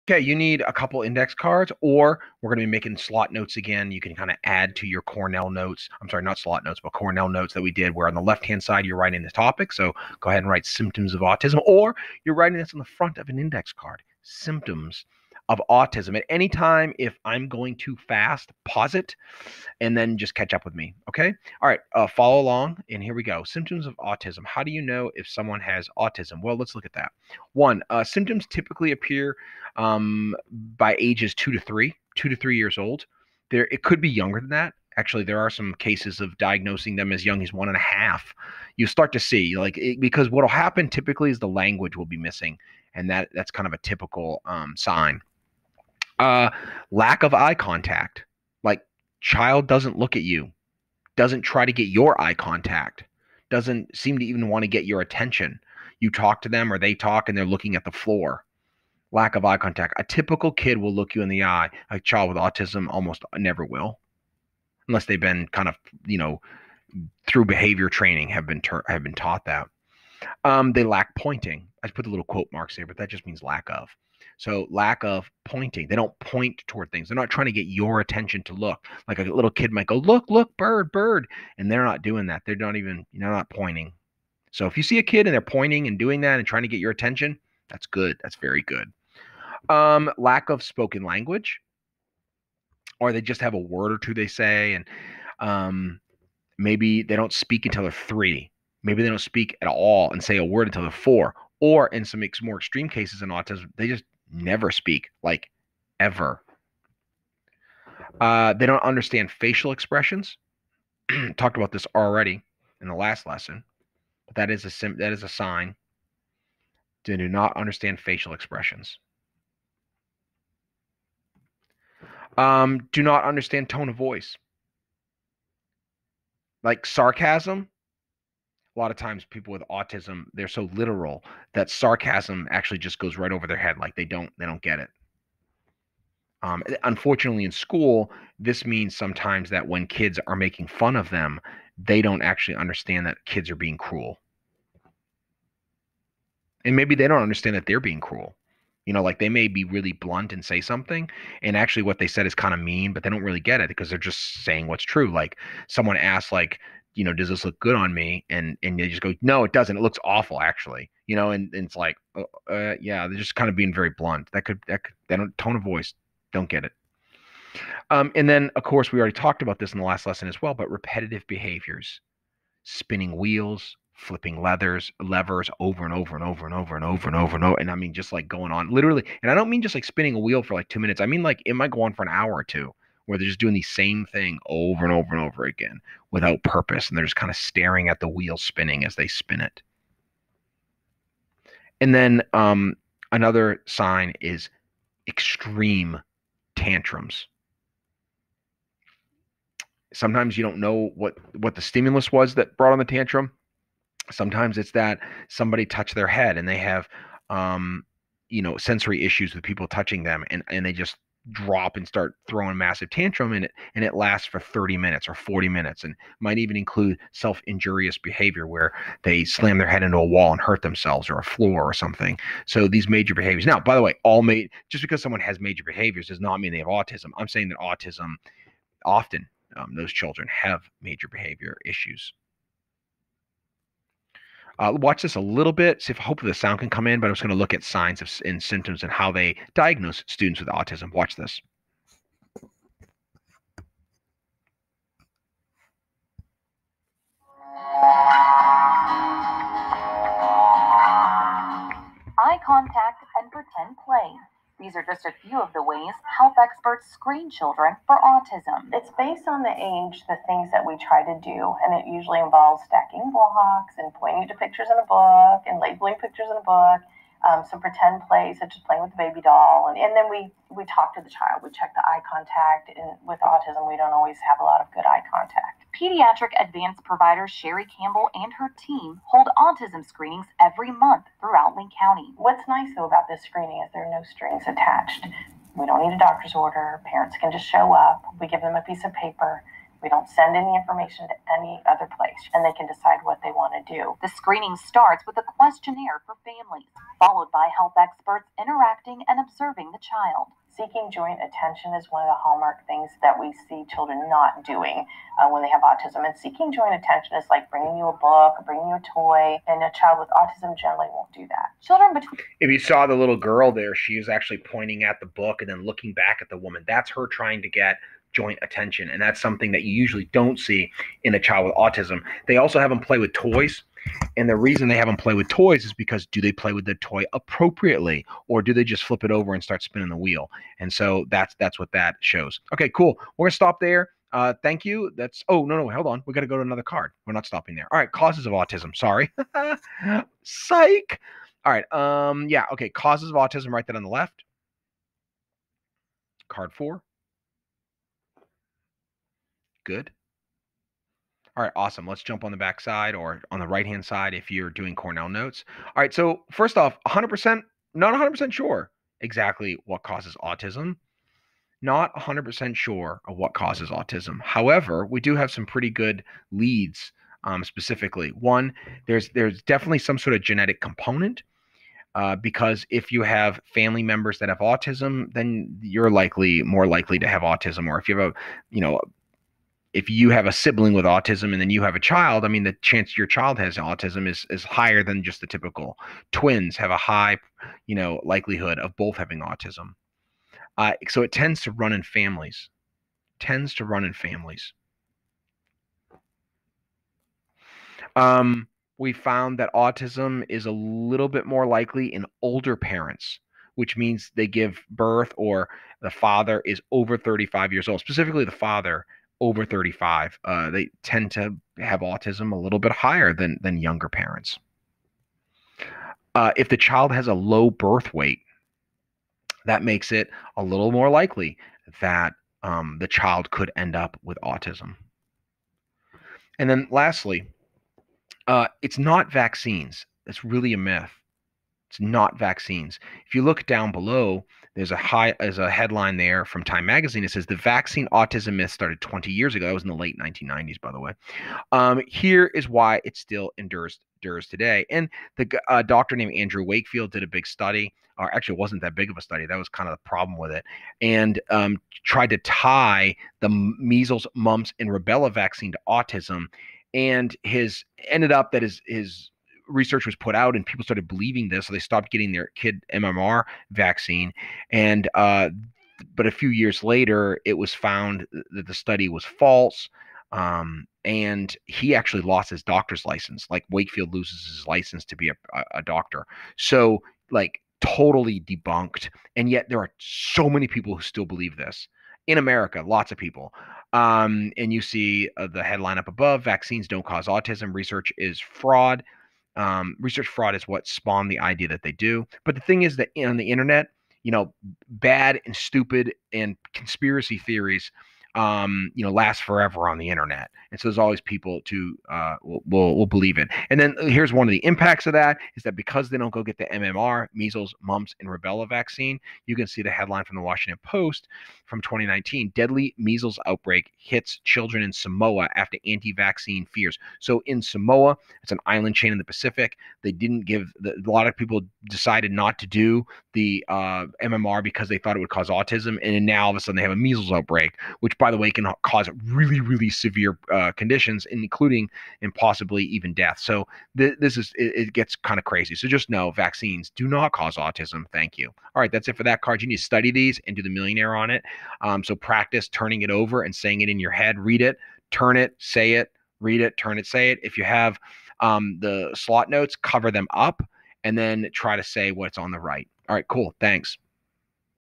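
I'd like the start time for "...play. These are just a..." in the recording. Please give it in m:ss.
4:13.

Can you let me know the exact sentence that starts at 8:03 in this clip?
Um, and you see uh, the headline up above vaccines don't cause autism, research is fraud.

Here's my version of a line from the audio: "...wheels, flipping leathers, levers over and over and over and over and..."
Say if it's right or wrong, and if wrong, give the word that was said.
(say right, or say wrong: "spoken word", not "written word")
right.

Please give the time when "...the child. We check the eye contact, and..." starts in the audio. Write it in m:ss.
4:31.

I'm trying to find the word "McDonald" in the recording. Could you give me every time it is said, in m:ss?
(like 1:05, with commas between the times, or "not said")
not said.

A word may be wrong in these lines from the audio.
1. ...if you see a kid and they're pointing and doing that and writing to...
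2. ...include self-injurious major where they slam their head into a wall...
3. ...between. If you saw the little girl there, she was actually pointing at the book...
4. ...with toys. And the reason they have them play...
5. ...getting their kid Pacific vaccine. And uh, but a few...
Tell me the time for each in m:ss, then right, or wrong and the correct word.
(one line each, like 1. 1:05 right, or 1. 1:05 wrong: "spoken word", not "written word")
1. 1:24 wrong: "trying", not "writing"
2. 3:36 wrong: "behavior", not "major"
3. 5:11 right
4. 5:22 right
5. 7:41 wrong: "MMR", not "Pacific".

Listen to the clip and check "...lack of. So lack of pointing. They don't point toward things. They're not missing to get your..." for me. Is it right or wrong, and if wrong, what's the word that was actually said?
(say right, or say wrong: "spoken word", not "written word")
wrong: "trying", not "missing".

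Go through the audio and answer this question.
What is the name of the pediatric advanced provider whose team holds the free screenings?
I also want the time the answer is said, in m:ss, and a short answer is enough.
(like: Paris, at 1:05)
Sherry Campbell, at 4:37.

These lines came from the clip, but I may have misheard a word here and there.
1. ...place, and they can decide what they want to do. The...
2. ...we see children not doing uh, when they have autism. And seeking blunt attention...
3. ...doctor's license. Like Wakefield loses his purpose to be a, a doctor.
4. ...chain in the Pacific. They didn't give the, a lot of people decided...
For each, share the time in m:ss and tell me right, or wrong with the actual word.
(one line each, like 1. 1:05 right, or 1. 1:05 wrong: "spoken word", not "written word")
1. 4:51 right
2. 5:03 wrong: "joint", not "blunt"
3. 7:52 wrong: "license", not "purpose"
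4. 8:38 right.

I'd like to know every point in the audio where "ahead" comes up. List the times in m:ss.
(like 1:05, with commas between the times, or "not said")
0:10.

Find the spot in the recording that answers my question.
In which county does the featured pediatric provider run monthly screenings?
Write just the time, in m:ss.
4:41.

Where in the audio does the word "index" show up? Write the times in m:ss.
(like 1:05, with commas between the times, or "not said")
0:01, 0:13.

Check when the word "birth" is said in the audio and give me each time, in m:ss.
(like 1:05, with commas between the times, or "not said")
6:44, 6:57.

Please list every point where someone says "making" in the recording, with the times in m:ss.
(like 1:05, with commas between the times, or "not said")
0:02, 2:20.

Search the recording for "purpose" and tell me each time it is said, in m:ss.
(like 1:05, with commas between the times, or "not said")
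3:06.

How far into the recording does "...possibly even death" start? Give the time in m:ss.
8:52.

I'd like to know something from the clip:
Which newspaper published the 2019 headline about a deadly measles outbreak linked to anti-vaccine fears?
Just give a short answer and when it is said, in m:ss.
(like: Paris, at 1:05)
Washington Post, at 8:30.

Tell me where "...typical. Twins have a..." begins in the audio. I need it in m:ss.
6:25.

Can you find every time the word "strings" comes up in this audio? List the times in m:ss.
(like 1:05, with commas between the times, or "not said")
4:44.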